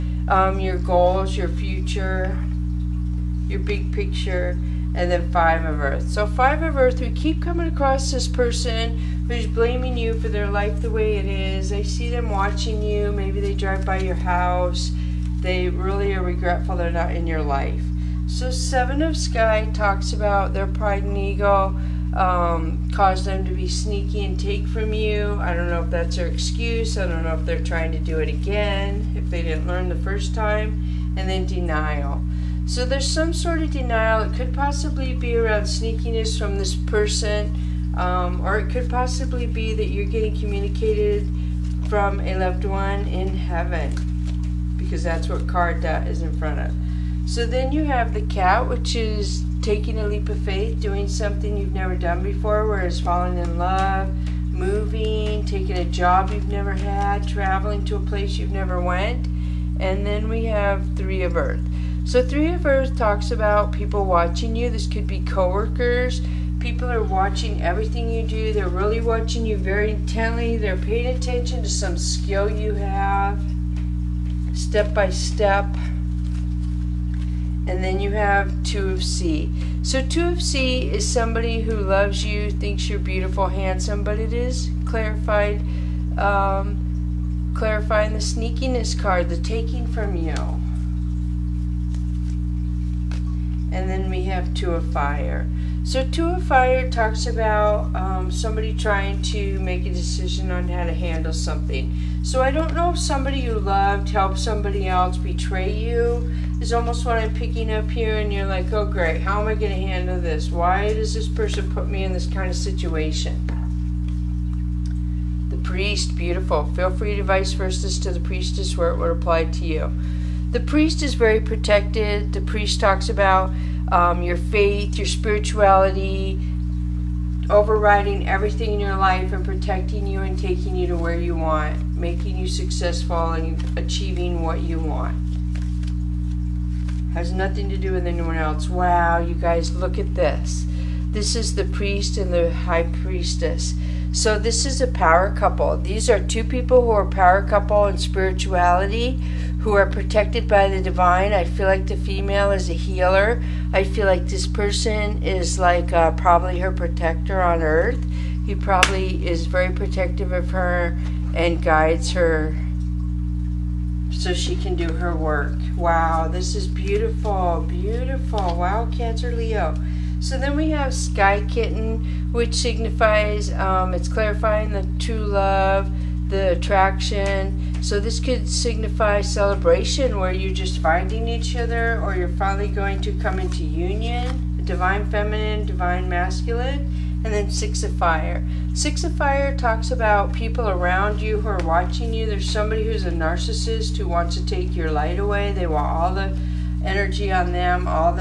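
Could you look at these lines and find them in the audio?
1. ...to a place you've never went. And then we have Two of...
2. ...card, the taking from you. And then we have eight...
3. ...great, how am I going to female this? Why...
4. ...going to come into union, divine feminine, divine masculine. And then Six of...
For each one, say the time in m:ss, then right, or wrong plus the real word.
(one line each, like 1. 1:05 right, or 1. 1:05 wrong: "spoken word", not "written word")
1. 0:57 wrong: "Three", not "Two"
2. 1:28 wrong: "two", not "eight"
3. 1:48 wrong: "handle", not "female"
4. 3:02 right.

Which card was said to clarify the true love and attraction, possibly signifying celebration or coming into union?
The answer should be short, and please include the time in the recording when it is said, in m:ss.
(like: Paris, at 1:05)
Sky Kitten, at 2:50.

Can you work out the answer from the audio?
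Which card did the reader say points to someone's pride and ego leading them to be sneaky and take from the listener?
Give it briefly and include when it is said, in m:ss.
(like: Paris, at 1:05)
Seven of Sky, at 0:18.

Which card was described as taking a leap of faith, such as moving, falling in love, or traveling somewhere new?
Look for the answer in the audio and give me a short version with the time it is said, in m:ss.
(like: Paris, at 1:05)
The cat, at 0:48.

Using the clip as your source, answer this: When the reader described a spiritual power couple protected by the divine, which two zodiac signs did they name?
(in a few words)
Cancer Leo.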